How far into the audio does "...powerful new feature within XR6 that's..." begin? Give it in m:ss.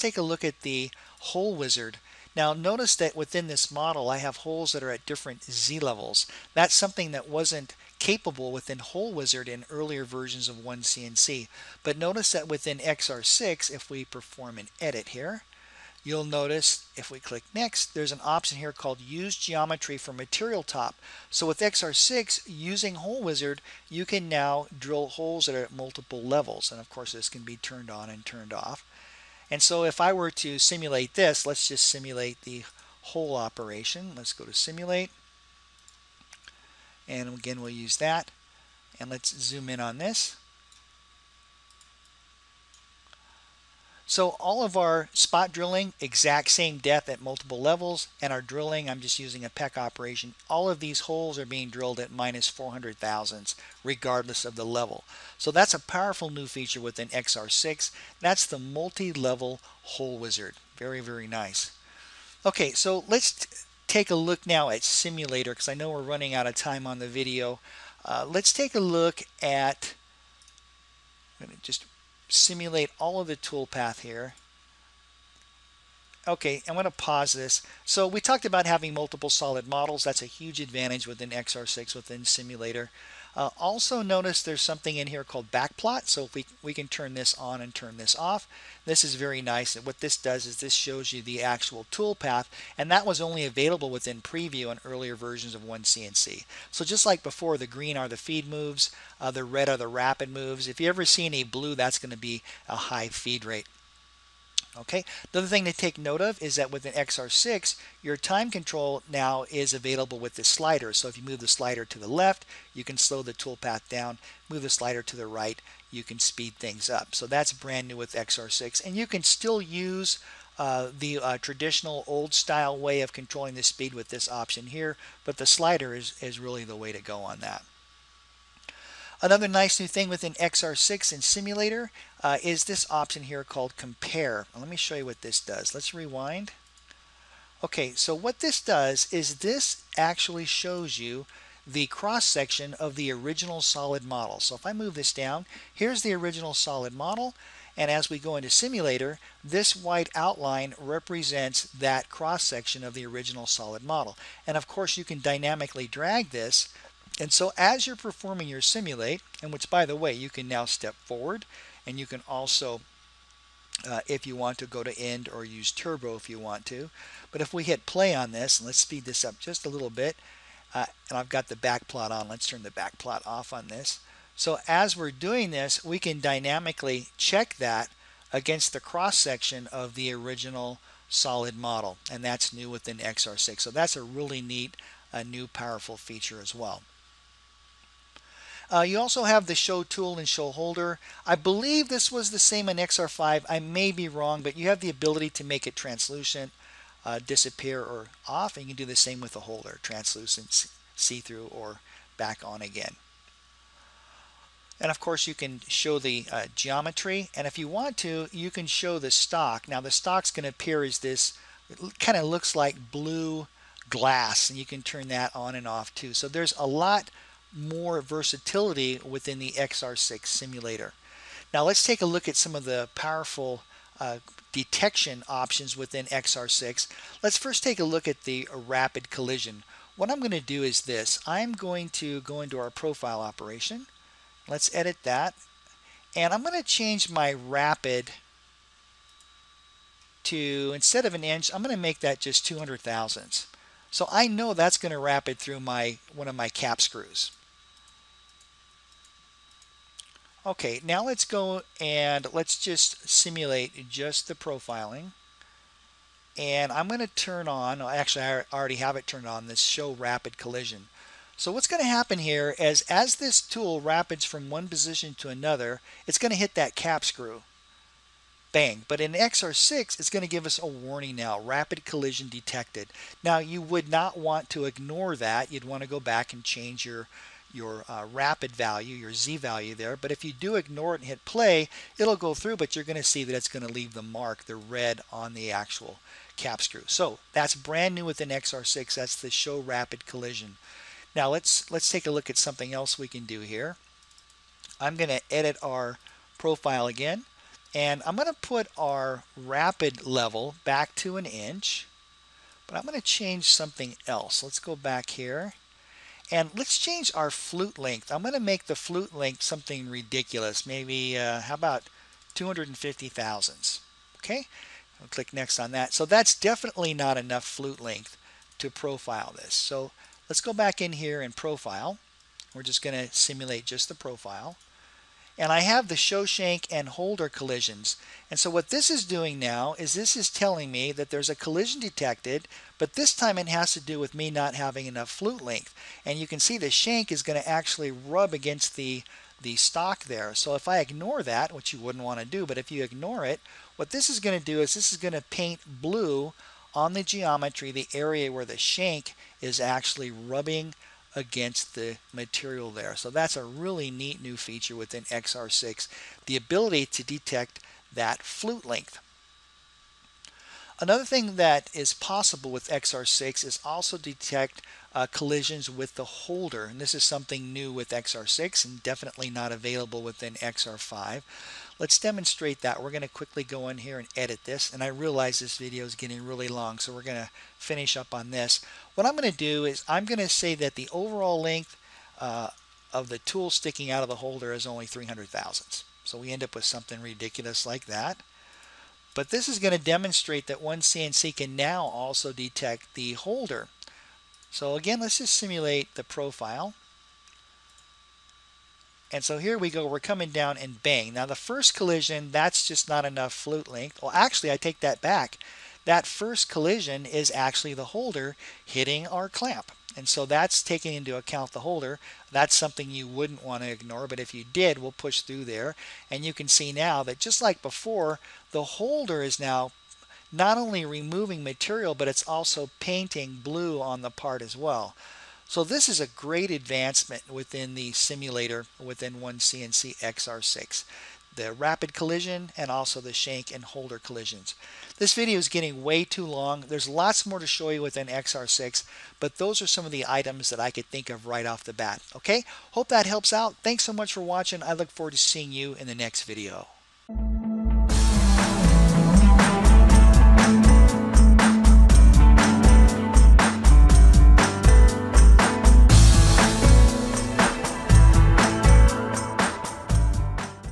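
0:55.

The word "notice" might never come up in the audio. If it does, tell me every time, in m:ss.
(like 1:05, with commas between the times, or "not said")
0:02, 0:11, 0:16, 1:24.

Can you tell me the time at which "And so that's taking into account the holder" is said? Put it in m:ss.
6:49.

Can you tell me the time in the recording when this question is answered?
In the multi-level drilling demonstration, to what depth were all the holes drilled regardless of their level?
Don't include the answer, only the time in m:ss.
0:52.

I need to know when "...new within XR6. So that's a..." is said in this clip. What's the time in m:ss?
3:02.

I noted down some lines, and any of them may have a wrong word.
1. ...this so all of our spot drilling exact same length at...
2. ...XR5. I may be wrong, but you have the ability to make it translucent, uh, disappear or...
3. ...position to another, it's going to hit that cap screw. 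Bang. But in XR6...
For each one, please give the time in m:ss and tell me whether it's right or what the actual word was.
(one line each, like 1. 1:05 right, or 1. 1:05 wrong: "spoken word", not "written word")
1. 0:39 wrong: "depth", not "length"
2. 3:12 right
3. 4:24 right.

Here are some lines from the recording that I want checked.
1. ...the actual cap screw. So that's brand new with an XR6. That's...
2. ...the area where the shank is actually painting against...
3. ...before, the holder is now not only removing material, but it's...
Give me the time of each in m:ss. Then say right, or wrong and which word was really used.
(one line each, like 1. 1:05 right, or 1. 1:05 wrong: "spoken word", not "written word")
1. 4:45 right
2. 5:47 wrong: "rubbing", not "painting"
3. 6:57 right.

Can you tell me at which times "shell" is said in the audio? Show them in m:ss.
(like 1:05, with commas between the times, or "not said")
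not said.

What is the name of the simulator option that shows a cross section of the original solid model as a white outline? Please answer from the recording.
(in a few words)
Compare.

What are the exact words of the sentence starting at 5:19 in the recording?
So let's go back in here and profile.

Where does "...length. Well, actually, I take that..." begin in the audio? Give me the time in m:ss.
6:43.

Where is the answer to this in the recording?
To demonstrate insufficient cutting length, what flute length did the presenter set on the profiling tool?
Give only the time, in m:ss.
5:12.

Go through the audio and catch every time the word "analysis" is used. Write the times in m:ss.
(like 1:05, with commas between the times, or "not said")
not said.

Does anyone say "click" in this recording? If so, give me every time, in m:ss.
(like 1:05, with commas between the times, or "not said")
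0:17, 5:15.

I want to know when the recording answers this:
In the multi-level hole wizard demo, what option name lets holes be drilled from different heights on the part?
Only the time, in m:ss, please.
0:18.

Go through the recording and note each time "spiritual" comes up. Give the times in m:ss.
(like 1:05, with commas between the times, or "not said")
not said.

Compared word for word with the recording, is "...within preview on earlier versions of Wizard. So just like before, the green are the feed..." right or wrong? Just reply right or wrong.
wrong.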